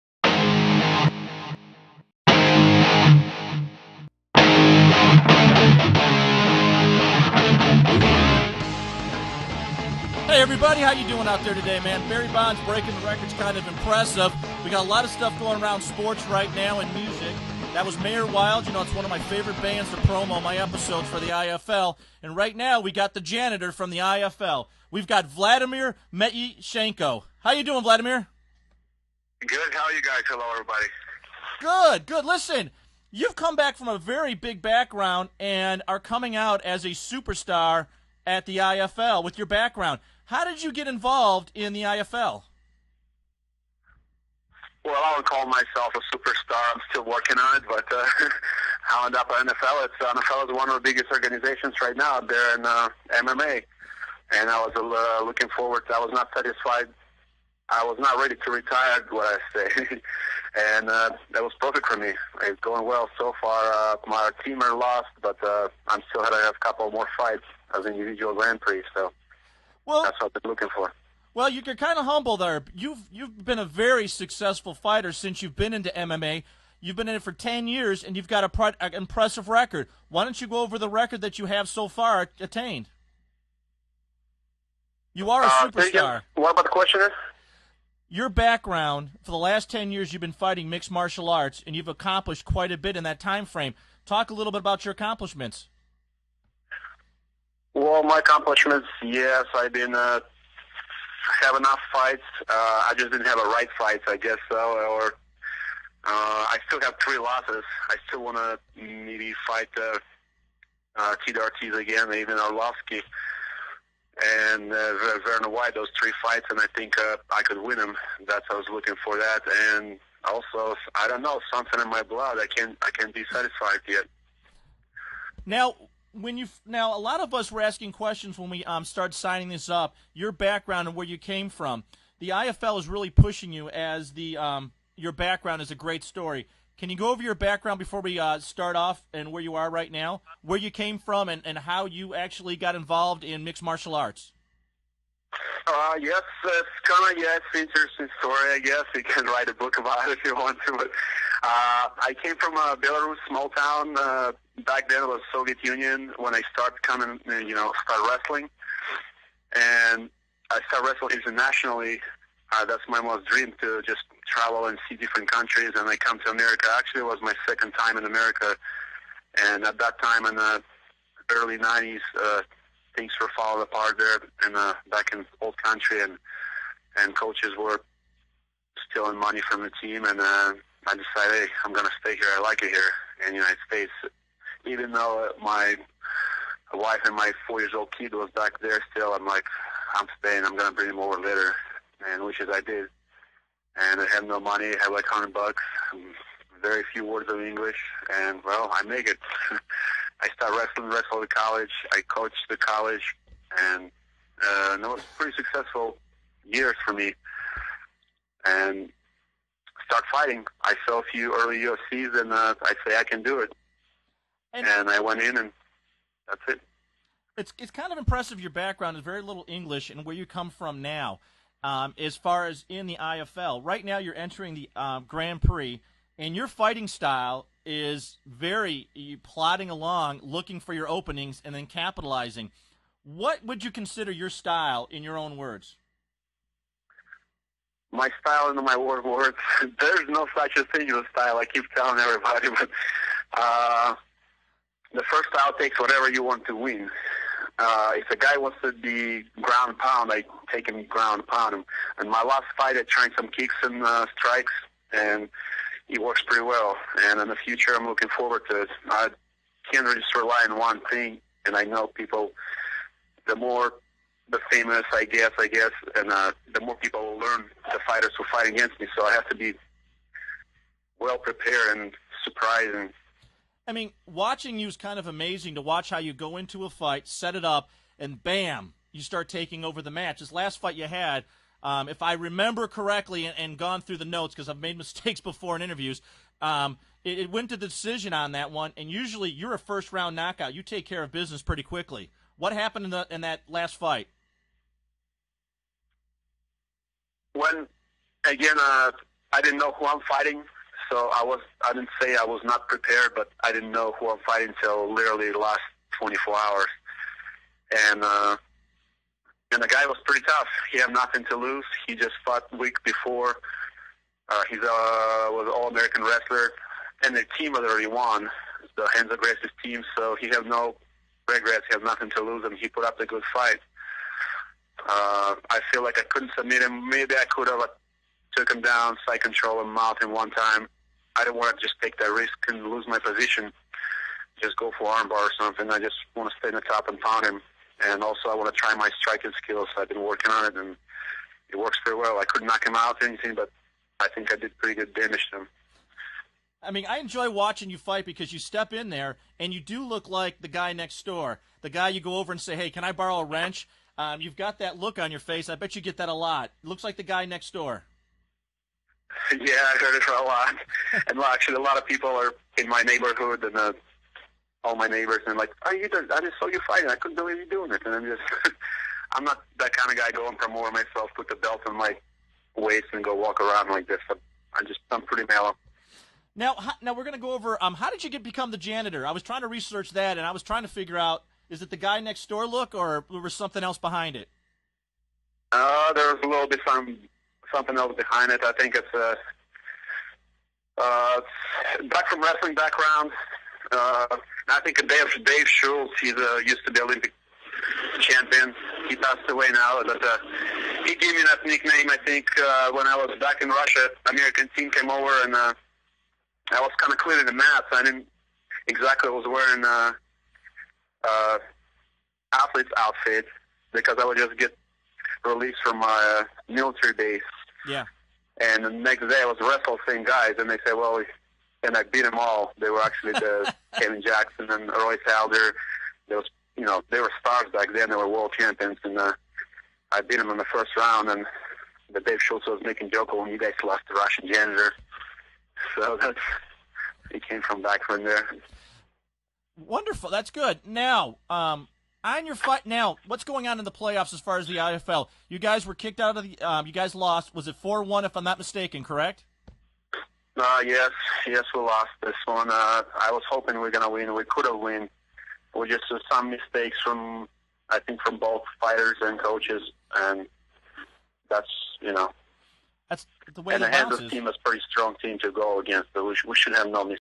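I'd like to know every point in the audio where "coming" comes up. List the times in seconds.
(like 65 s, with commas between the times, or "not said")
36 s, 156 s.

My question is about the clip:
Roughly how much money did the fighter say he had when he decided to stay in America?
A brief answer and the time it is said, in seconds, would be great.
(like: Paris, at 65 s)
$100, at 195 s.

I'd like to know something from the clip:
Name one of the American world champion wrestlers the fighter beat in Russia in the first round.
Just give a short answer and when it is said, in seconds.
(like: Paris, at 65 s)
Kevin Jackson, at 423 s.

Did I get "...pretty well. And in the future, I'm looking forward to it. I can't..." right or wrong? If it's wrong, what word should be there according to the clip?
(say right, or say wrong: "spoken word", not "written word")
right.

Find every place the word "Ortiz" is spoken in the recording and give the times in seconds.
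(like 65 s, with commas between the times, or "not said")
111 s.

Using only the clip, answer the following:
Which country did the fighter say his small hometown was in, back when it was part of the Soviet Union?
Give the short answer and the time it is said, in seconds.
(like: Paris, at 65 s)
Belarus, at 152 s.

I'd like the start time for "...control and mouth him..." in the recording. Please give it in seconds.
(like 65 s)
329 s.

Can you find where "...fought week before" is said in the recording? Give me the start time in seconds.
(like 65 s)
312 s.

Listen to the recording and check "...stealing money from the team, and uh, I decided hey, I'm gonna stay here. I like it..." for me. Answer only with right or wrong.
right.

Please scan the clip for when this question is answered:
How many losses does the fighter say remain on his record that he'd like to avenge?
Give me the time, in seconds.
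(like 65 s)
107 s.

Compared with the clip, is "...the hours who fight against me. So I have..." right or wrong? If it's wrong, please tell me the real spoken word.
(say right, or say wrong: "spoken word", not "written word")
wrong: "fighters", not "hours".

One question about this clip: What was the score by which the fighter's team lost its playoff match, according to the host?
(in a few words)
4-1.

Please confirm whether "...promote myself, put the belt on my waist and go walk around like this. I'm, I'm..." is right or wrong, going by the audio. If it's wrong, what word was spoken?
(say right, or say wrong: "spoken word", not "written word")
right.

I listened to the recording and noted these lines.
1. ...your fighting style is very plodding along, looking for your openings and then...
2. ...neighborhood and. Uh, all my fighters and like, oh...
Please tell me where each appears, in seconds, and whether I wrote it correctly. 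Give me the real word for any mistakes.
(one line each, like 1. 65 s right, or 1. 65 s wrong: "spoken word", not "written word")
1. 226 s right
2. 362 s wrong: "neighbors", not "fighters".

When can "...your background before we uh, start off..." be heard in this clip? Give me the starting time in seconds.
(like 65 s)
137 s.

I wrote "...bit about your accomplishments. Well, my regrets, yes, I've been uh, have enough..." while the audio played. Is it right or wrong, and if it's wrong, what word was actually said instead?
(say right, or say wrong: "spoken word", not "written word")
wrong: "accomplishments", not "regrets".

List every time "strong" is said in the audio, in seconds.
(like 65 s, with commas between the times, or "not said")
464 s.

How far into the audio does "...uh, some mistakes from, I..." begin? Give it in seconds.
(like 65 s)
455 s.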